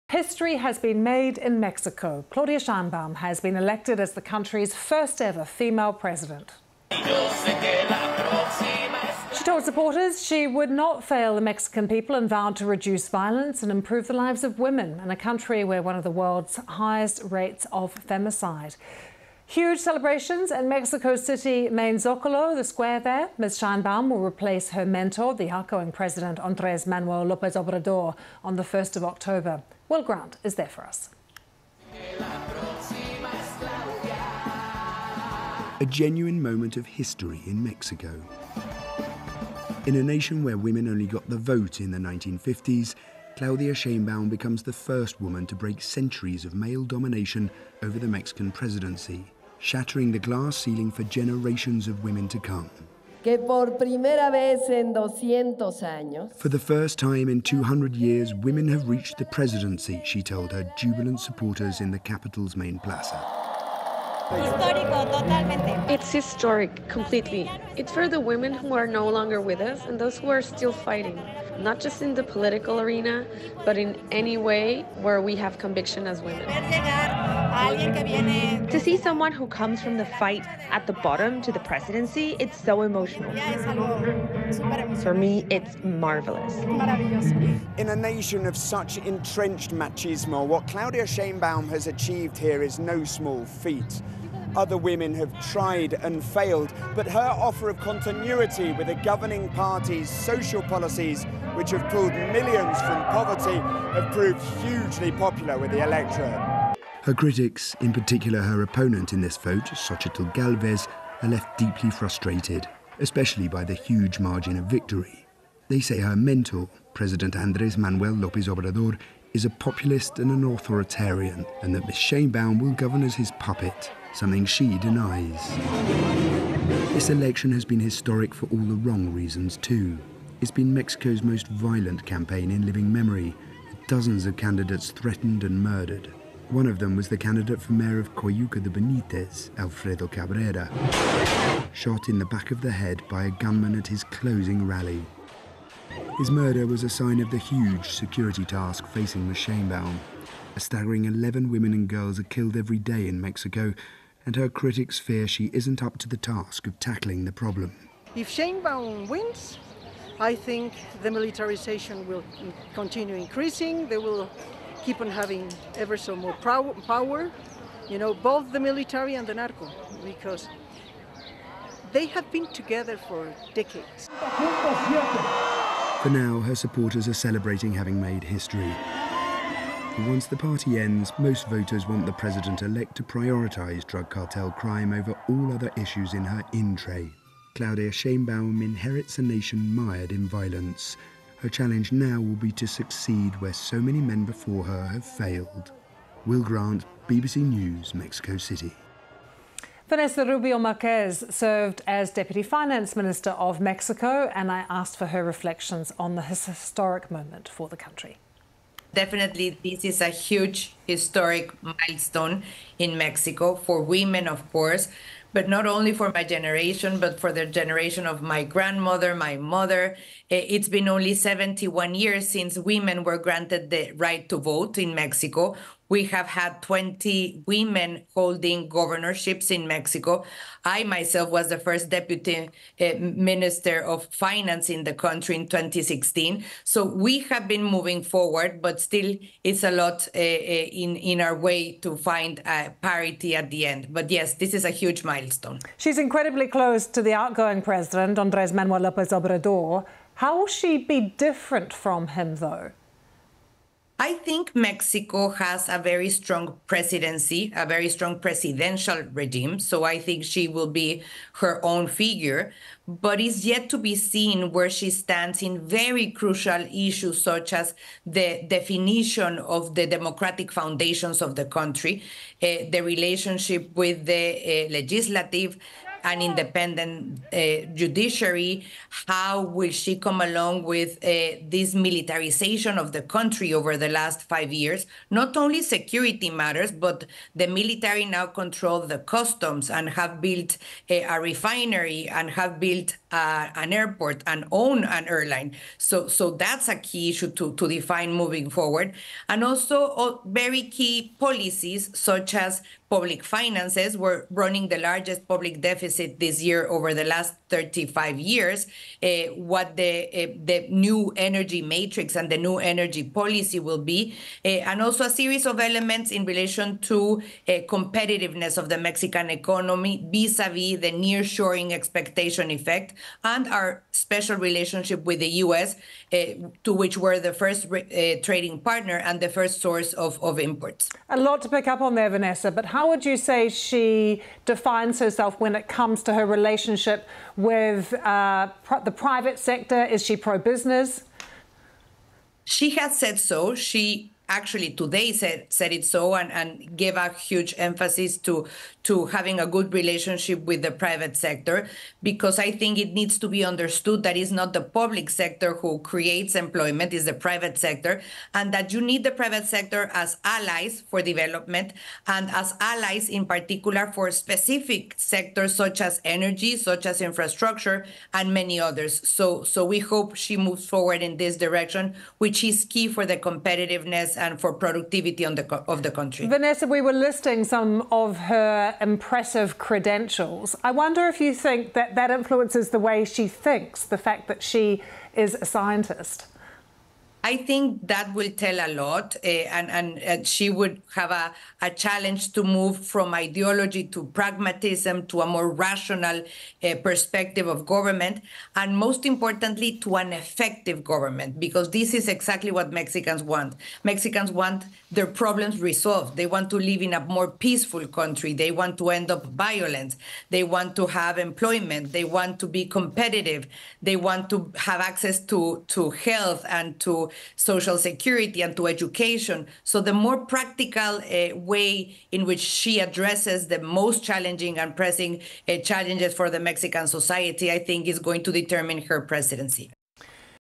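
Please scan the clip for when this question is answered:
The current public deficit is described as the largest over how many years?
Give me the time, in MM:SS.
05:07.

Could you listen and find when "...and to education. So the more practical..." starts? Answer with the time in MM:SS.
06:58.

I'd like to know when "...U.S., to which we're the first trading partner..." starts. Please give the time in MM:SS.
05:25.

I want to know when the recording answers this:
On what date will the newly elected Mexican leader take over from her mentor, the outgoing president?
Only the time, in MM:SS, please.
00:28.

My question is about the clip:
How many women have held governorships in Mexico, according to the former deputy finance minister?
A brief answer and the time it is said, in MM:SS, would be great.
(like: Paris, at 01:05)
20, at 03:46.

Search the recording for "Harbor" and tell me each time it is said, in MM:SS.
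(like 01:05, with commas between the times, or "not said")
not said.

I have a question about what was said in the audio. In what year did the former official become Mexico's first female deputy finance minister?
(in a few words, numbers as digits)
2016.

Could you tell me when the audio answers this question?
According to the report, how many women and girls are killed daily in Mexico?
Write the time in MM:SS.
02:31.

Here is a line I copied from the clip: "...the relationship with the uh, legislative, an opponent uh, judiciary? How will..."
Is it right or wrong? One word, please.
wrong.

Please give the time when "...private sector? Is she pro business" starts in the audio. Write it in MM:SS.
05:38.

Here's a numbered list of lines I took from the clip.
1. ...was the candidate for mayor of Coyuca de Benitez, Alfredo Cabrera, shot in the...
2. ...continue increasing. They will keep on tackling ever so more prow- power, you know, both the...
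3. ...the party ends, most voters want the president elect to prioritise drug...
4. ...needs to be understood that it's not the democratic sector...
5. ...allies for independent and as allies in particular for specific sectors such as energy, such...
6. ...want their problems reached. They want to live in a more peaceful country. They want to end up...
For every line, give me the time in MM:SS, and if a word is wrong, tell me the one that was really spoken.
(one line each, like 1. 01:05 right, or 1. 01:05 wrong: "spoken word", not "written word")
1. 02:16 right
2. 02:42 wrong: "having", not "tackling"
3. 03:00 right
4. 05:52 wrong: "public", not "democratic"
5. 06:00 wrong: "development", not "independent"
6. 06:44 wrong: "resolved", not "reached".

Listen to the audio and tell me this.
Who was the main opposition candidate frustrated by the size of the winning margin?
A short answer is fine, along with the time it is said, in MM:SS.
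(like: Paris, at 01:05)
Xochitl Galvez, at 01:49.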